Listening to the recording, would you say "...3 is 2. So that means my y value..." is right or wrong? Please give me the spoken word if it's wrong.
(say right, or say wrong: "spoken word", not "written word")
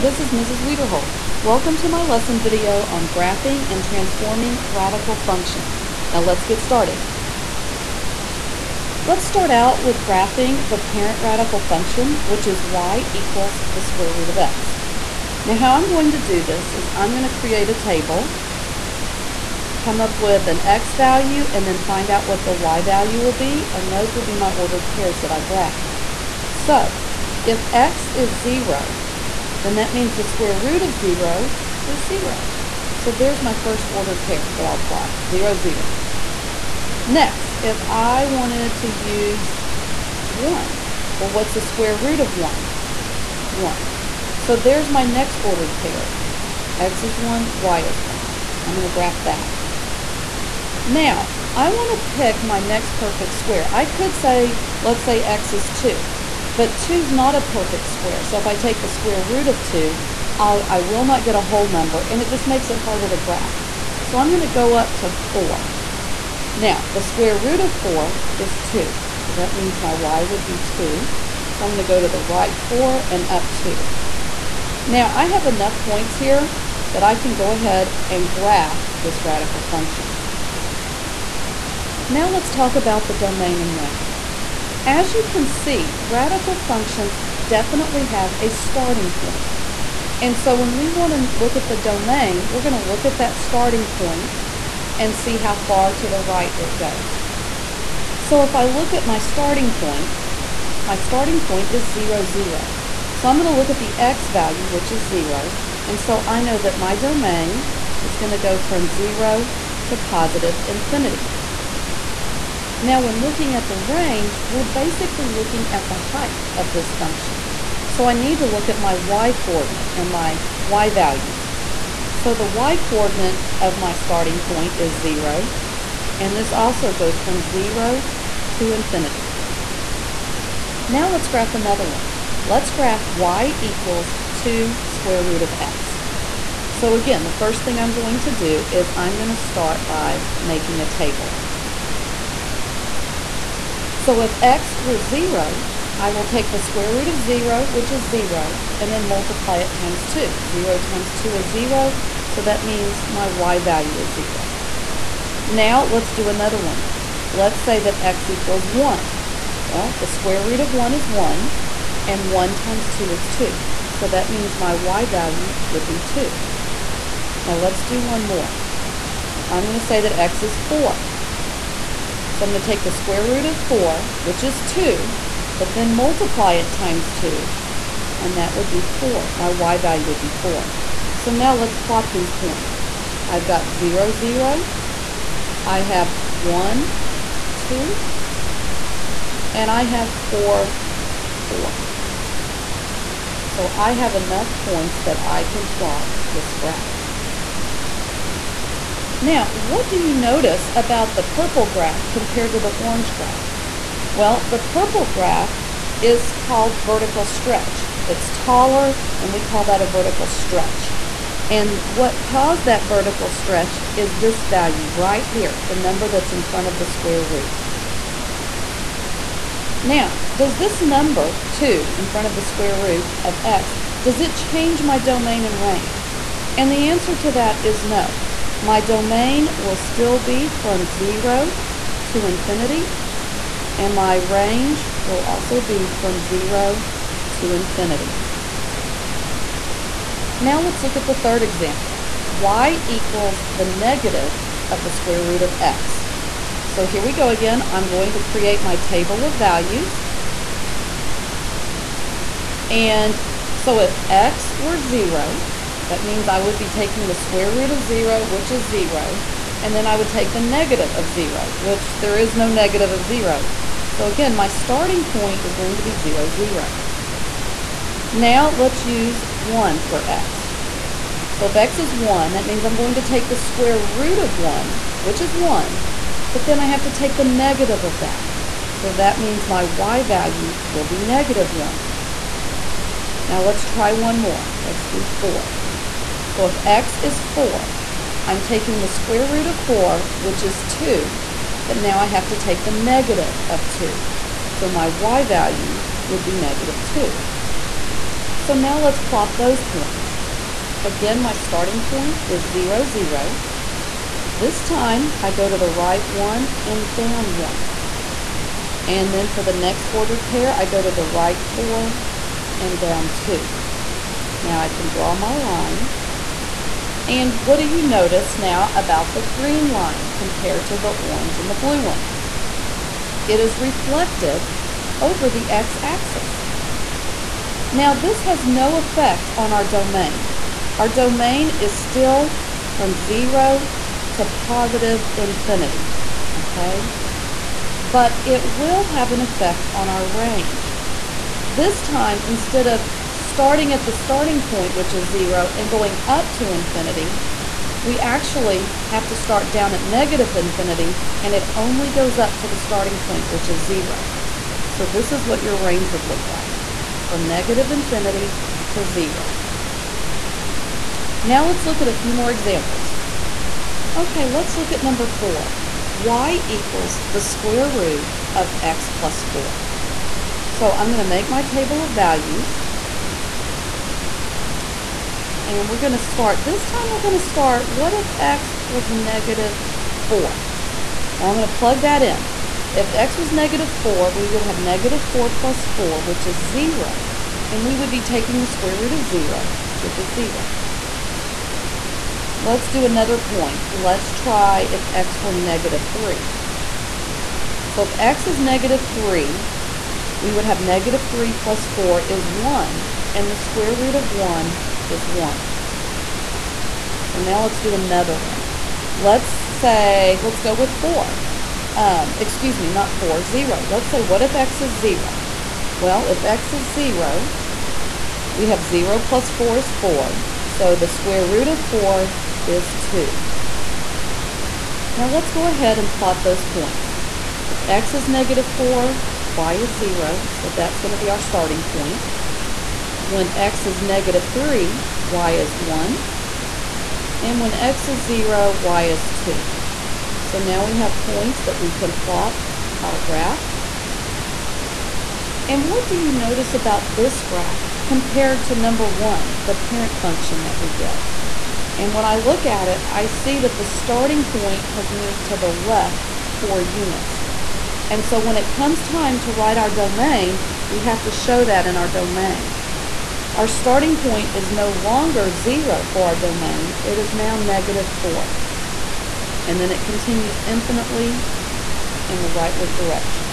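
wrong: "2", not "3".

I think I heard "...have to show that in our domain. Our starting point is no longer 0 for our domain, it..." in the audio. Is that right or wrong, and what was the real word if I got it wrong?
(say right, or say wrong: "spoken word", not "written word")
right.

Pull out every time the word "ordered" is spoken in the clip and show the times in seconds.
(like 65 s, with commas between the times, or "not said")
24 s, 33 s, 45 s, 309 s.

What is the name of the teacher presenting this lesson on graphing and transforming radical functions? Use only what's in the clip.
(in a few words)
Mrs. Wiederhold.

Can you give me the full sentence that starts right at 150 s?
0 times 2 is 0, so that means my y value is 0.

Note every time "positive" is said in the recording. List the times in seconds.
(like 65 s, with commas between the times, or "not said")
109 s, 334 s.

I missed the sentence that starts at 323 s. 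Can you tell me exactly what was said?
It is reflected over the x-axis.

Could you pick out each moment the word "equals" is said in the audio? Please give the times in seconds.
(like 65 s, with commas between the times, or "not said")
13 s, 133 s, 158 s, 242 s, 366 s.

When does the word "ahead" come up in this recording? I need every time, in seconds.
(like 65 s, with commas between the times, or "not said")
77 s, 425 s.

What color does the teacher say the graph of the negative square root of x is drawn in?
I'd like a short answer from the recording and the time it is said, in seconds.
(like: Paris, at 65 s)
green, at 319 s.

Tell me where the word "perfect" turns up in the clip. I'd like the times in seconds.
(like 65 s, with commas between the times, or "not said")
52 s, 57 s.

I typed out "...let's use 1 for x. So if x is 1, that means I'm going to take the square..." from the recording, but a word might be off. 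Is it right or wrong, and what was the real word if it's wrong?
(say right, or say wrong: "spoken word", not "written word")
right.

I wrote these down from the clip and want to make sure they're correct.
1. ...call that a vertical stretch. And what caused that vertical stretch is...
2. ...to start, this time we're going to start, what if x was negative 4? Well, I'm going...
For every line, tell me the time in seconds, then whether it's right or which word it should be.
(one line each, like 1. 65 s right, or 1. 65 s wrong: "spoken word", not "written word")
1. 209 s right
2. 375 s right.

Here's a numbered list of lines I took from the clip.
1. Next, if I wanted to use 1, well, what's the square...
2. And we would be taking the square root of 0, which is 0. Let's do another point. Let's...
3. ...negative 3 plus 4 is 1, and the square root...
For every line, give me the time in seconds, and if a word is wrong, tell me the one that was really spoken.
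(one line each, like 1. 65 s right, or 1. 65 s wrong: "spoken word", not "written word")
1. 37 s right
2. 387 s right
3. 400 s right.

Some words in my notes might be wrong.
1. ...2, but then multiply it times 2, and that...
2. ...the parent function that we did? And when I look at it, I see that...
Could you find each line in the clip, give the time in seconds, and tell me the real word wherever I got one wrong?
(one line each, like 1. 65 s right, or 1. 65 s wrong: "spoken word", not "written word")
1. 174 s right
2. 449 s right.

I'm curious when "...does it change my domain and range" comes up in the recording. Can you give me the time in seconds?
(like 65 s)
224 s.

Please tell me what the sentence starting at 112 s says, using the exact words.
Now, when looking at the range, we're basically looking at the height of this function.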